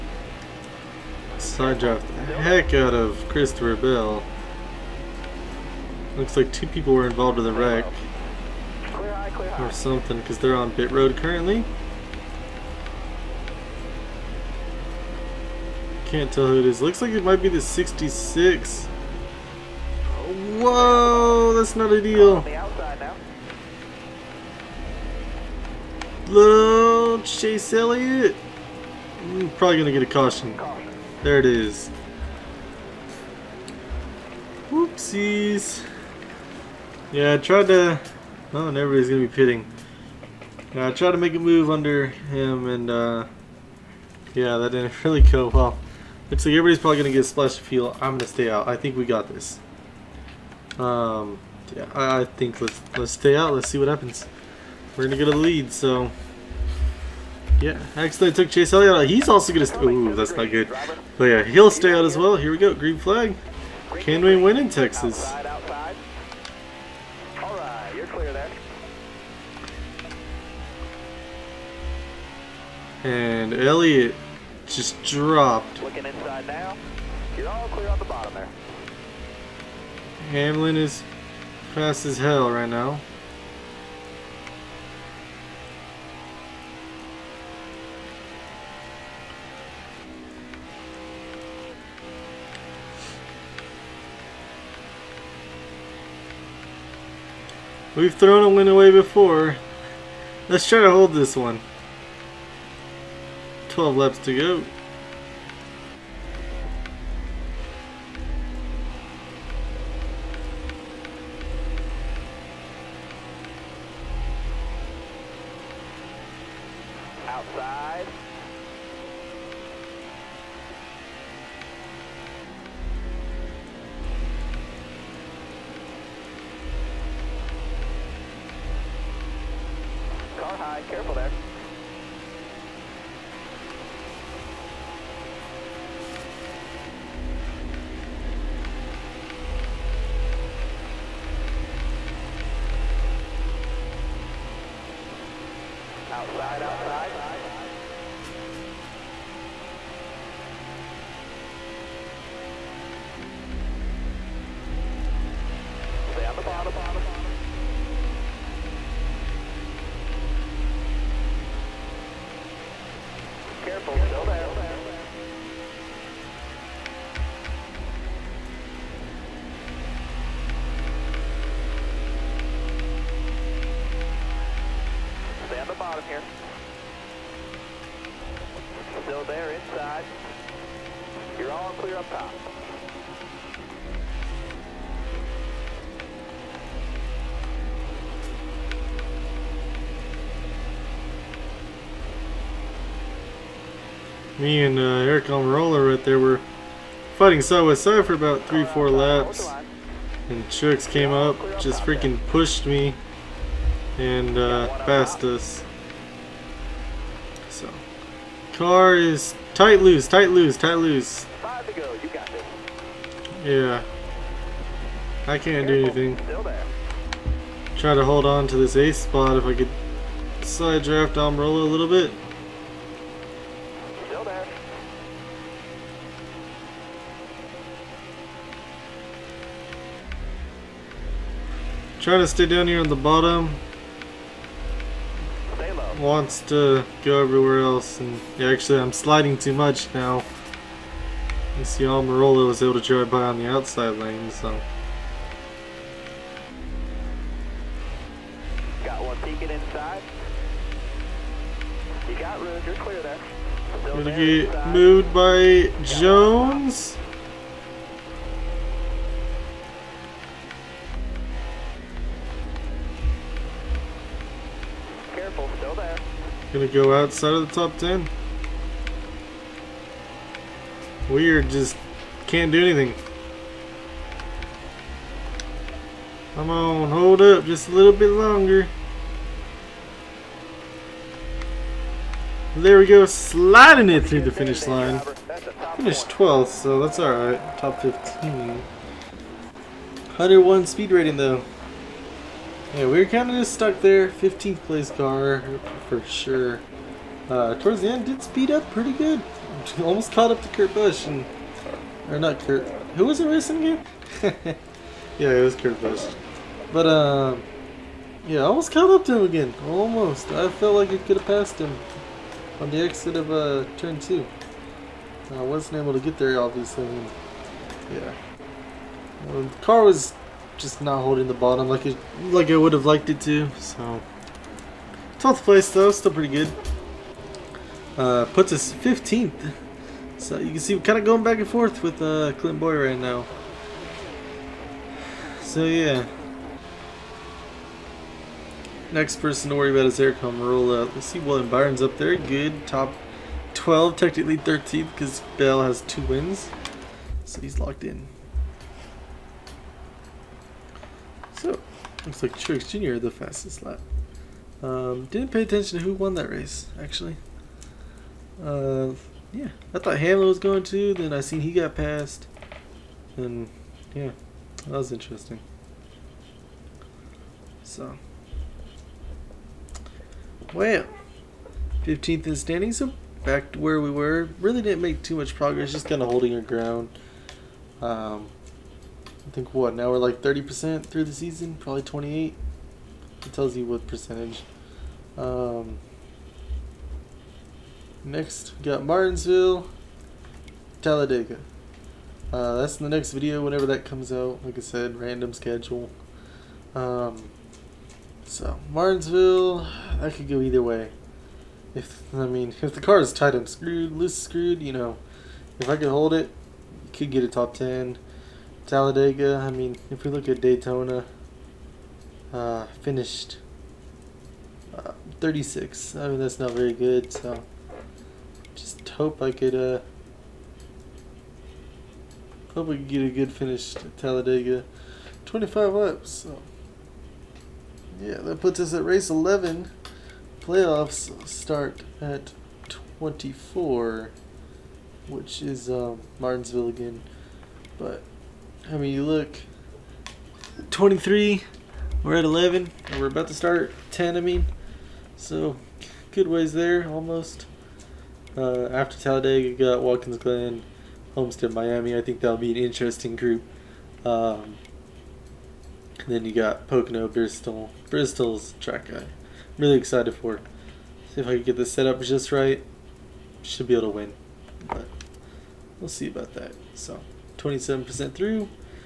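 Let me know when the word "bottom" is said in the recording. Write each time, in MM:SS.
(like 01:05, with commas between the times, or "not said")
01:18, 03:52, 05:21.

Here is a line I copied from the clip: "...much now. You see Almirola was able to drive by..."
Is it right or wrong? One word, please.
right.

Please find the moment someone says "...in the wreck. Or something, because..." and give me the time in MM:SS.
00:07.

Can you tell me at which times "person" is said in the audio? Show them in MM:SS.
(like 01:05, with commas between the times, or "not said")
05:39.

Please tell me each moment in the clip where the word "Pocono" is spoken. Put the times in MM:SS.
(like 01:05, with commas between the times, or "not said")
07:36.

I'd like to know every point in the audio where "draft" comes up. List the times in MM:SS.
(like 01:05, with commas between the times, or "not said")
00:01, 03:40.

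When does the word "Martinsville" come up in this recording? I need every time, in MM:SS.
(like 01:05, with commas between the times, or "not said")
06:28, 06:38, 07:16.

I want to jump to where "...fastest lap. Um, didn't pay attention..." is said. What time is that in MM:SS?
05:53.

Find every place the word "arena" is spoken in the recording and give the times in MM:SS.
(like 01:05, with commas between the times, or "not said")
not said.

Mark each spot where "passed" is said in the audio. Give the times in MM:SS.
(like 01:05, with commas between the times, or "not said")
03:24, 05:11, 06:01.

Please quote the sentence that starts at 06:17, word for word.
Um, I think what now we're like 30% through the season, probably 28.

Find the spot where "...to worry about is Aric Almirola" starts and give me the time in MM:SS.
05:39.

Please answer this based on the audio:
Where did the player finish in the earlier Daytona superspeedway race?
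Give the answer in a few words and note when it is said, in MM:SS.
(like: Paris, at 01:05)
36th, at 06:52.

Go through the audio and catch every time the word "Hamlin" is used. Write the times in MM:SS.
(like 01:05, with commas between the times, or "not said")
01:20, 05:59.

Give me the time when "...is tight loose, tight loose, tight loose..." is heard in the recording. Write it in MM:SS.
03:28.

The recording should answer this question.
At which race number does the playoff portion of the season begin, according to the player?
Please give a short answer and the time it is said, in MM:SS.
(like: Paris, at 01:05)
24, at 07:10.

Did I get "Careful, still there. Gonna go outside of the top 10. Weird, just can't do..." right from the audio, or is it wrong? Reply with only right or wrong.
right.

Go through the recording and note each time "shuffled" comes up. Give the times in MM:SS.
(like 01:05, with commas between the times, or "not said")
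not said.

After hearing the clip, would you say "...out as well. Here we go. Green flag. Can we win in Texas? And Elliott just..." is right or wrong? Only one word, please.
right.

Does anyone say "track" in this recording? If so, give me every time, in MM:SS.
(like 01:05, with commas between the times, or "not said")
07:38.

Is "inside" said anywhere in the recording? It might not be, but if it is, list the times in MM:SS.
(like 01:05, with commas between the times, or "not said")
01:16, 04:09, 04:14.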